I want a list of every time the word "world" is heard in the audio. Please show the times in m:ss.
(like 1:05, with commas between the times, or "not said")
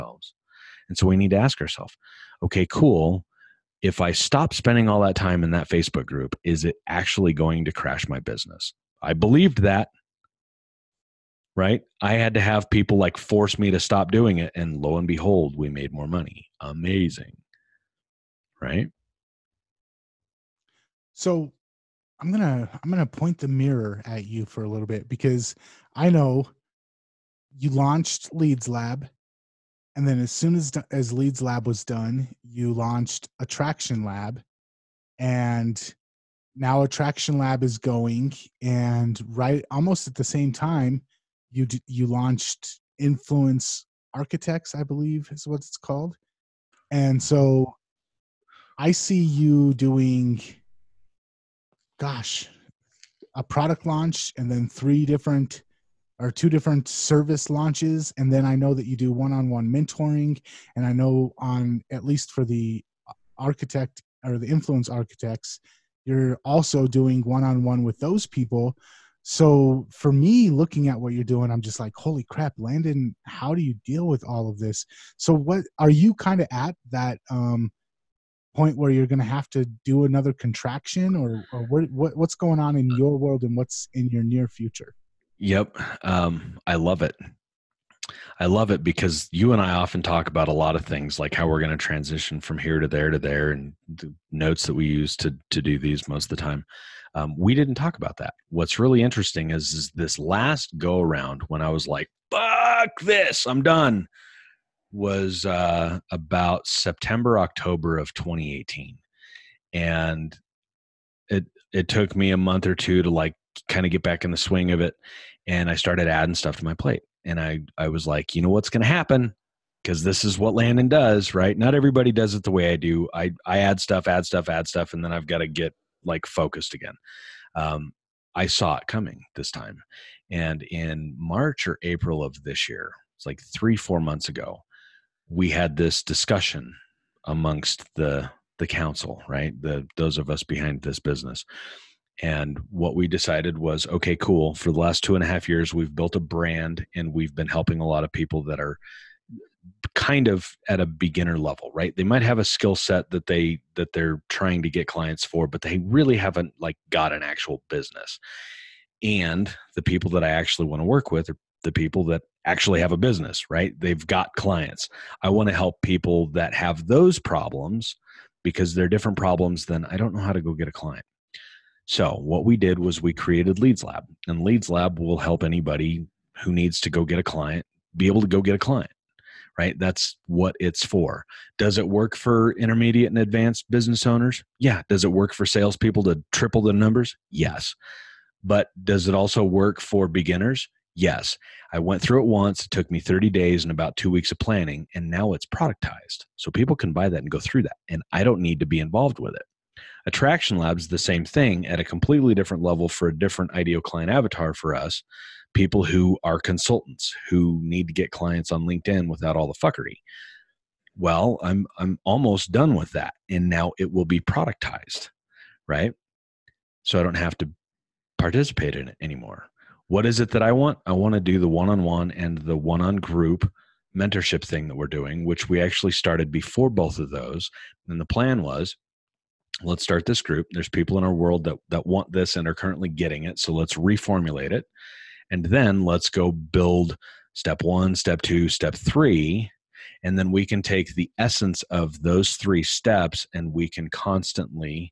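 1:23, 3:51.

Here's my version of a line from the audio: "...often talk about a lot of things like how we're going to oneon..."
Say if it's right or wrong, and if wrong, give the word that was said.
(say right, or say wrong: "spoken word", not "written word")
wrong: "transition", not "oneon".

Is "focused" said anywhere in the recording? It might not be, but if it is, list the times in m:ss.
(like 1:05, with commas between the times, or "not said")
2:06.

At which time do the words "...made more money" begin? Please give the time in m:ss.
0:15.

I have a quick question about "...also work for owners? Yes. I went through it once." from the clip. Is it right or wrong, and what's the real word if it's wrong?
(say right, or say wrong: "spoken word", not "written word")
wrong: "beginners", not "owners".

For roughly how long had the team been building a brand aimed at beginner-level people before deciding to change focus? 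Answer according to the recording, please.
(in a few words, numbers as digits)
2.5 years.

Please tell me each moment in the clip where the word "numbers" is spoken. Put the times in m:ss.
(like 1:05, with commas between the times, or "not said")
3:06.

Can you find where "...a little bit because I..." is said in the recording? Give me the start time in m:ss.
0:24.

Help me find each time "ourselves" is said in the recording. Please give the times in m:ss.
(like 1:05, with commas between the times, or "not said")
0:01.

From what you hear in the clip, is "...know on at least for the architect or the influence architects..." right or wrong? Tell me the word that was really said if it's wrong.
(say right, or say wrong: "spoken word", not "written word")
right.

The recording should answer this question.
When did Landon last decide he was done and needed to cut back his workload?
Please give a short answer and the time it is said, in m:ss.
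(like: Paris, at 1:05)
September, October of 2018, at 1:46.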